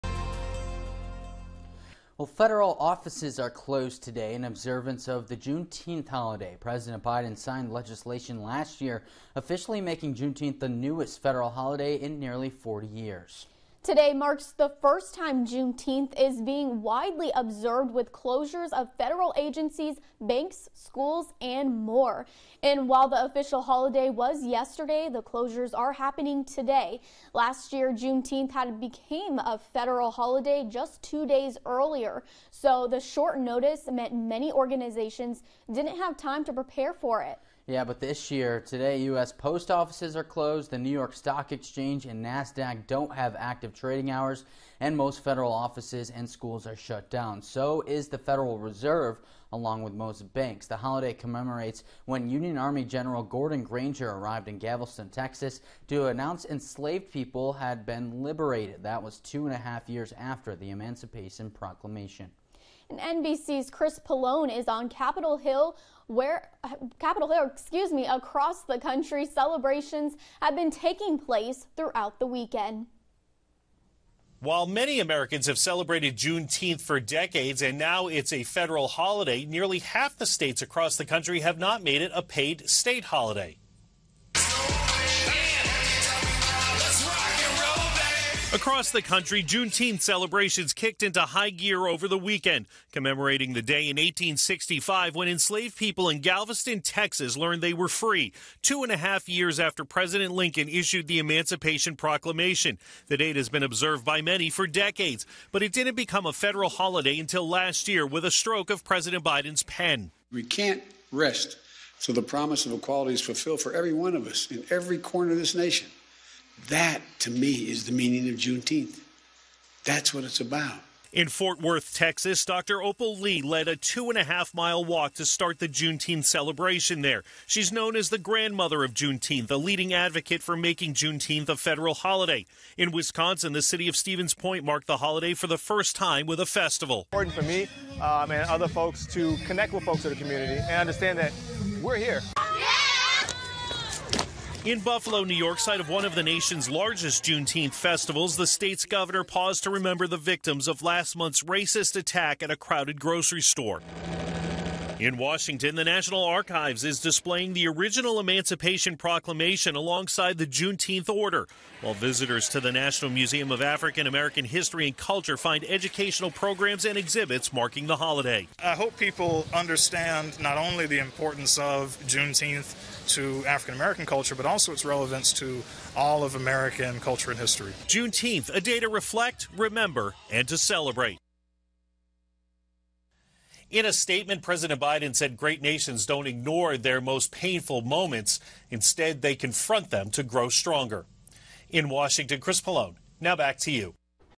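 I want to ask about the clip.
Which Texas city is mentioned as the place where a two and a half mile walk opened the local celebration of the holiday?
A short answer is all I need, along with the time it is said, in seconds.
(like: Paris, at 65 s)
Fort Worth, at 121 s.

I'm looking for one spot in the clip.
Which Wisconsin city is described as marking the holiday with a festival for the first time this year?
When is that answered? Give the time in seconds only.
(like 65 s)
133 s.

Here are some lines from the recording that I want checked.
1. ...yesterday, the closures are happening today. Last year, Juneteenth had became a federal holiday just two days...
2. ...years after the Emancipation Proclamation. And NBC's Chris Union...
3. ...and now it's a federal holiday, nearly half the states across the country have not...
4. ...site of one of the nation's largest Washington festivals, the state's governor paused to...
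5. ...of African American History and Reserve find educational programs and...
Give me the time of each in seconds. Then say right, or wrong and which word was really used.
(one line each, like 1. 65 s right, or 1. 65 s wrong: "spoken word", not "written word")
1. 24 s right
2. 59 s wrong: "Pollone", not "Union"
3. 77 s right
4. 145 s wrong: "Juneteenth", not "Washington"
5. 163 s wrong: "Culture", not "Reserve".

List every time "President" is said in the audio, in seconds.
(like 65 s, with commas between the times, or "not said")
6 s, 99 s, 108 s, 184 s.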